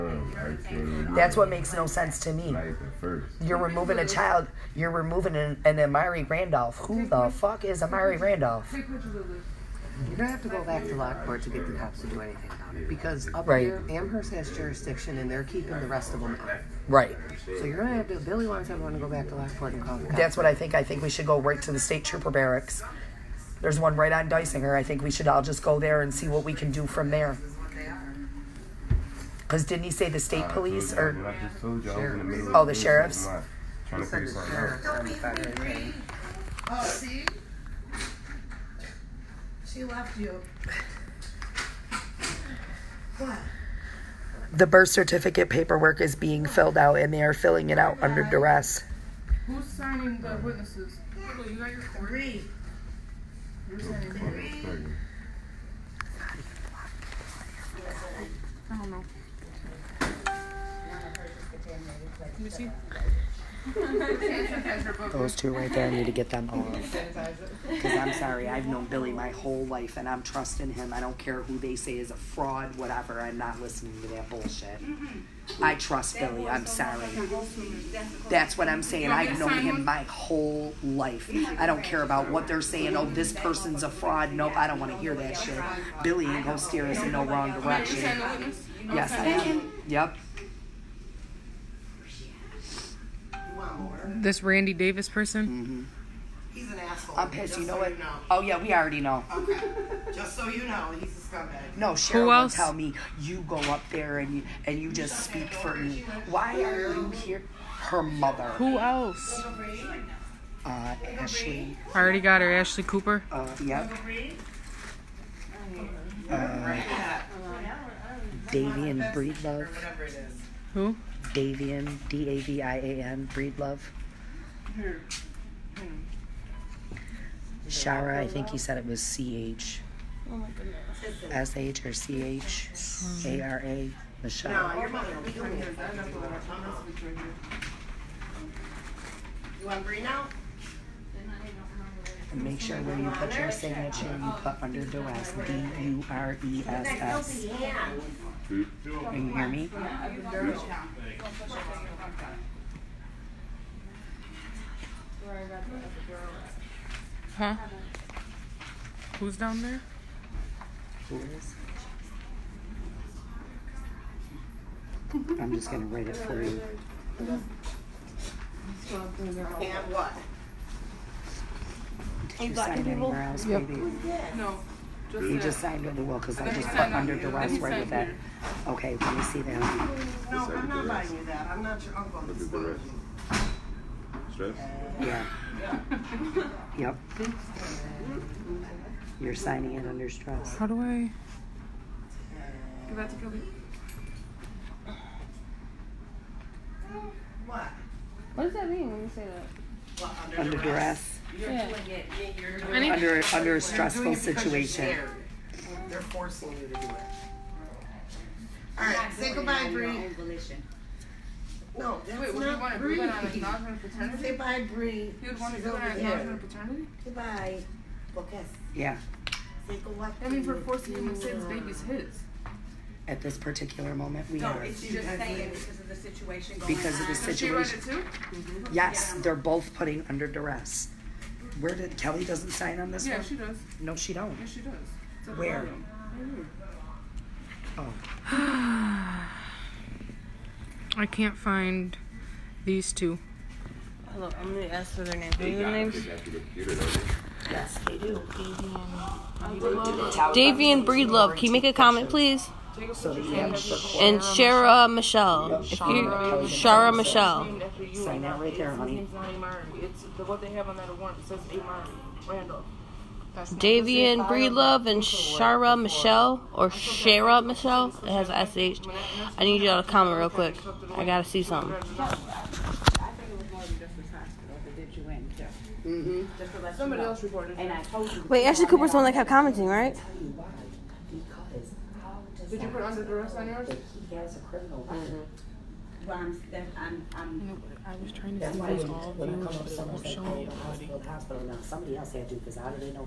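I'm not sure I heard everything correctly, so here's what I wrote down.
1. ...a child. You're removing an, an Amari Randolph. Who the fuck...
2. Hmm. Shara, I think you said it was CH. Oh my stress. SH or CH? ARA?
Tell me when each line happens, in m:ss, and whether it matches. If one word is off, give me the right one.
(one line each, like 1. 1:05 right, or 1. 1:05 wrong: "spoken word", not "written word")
1. 0:03 right
2. 2:05 wrong: "goodness", not "stress".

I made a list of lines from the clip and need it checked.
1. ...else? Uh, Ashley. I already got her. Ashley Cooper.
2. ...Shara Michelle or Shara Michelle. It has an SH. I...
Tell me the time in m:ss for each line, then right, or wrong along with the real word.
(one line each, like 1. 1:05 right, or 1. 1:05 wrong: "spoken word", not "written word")
1. 1:48 right
2. 4:25 right.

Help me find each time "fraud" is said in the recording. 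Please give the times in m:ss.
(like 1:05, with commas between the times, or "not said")
1:12, 1:23.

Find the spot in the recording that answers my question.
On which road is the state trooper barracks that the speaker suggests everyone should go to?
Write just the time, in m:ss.
0:24.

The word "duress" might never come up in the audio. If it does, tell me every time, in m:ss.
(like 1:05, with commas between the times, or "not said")
0:48, 2:24, 2:57, 3:20, 3:50, 4:43.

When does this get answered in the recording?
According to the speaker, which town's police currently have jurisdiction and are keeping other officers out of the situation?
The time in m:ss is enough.
0:13.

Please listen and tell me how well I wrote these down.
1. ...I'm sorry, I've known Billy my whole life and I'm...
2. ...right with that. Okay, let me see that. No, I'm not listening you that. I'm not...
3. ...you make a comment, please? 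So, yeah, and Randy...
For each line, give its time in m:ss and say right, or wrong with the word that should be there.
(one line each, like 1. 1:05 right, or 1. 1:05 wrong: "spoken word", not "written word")
1. 1:07 right
2. 2:57 wrong: "buying", not "listening"
3. 4:11 wrong: "Shara", not "Randy".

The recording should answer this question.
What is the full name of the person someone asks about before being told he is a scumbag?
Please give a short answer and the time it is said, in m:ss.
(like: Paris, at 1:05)
Randy Davis, at 1:34.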